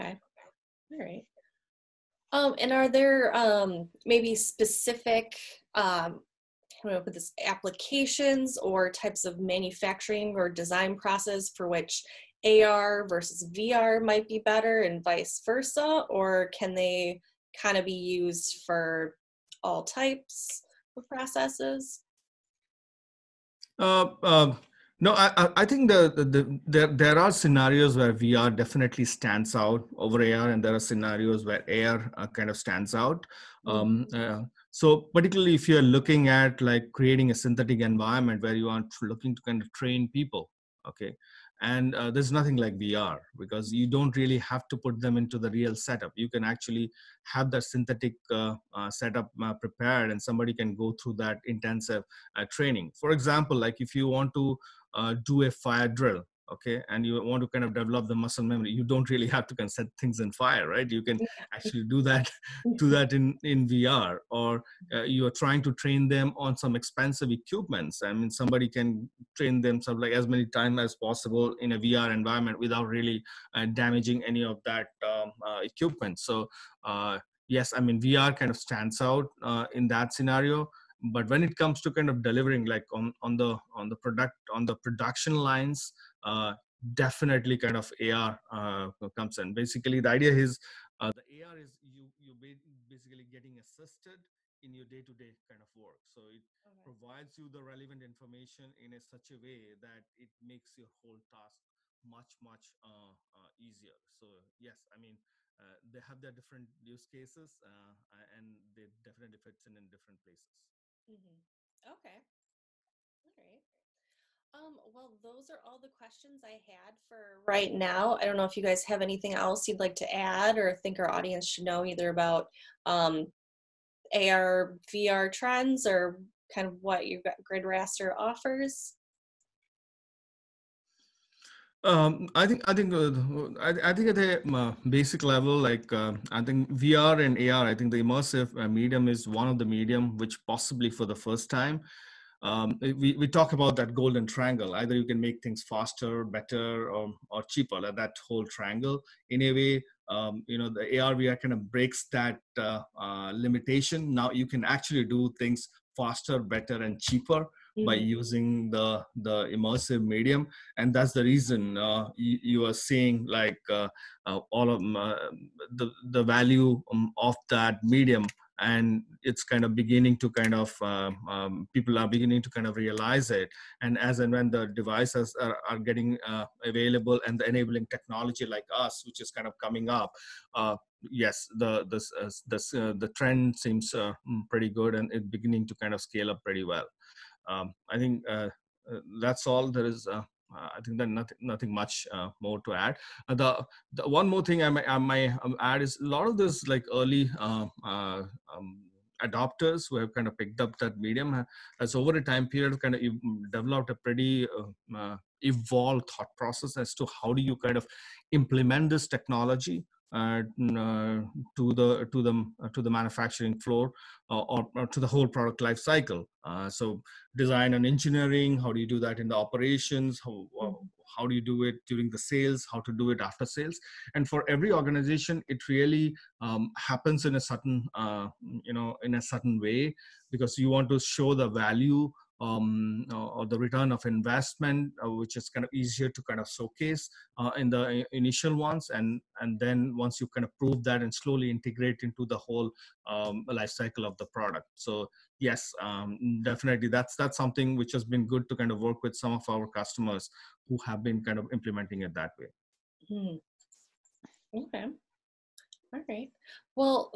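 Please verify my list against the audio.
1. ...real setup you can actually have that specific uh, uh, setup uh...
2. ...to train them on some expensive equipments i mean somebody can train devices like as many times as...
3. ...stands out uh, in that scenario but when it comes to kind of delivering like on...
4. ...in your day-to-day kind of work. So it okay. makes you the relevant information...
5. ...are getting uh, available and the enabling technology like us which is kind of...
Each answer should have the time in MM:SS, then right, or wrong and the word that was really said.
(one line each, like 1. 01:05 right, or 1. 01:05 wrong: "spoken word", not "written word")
1. 00:45 wrong: "synthetic", not "specific"
2. 01:05 wrong: "themselves", not "devices"
3. 01:18 right
4. 01:34 wrong: "provides", not "makes"
5. 02:55 right.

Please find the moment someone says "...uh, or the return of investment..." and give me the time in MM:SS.
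03:53.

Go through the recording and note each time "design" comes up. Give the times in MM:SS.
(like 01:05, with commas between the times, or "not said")
00:10, 03:37.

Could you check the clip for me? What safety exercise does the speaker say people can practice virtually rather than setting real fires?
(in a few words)
fire drill.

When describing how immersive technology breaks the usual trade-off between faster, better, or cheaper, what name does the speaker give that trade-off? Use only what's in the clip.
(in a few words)
golden triangle.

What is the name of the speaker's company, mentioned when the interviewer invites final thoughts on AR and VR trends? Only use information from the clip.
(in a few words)
Grid Raster.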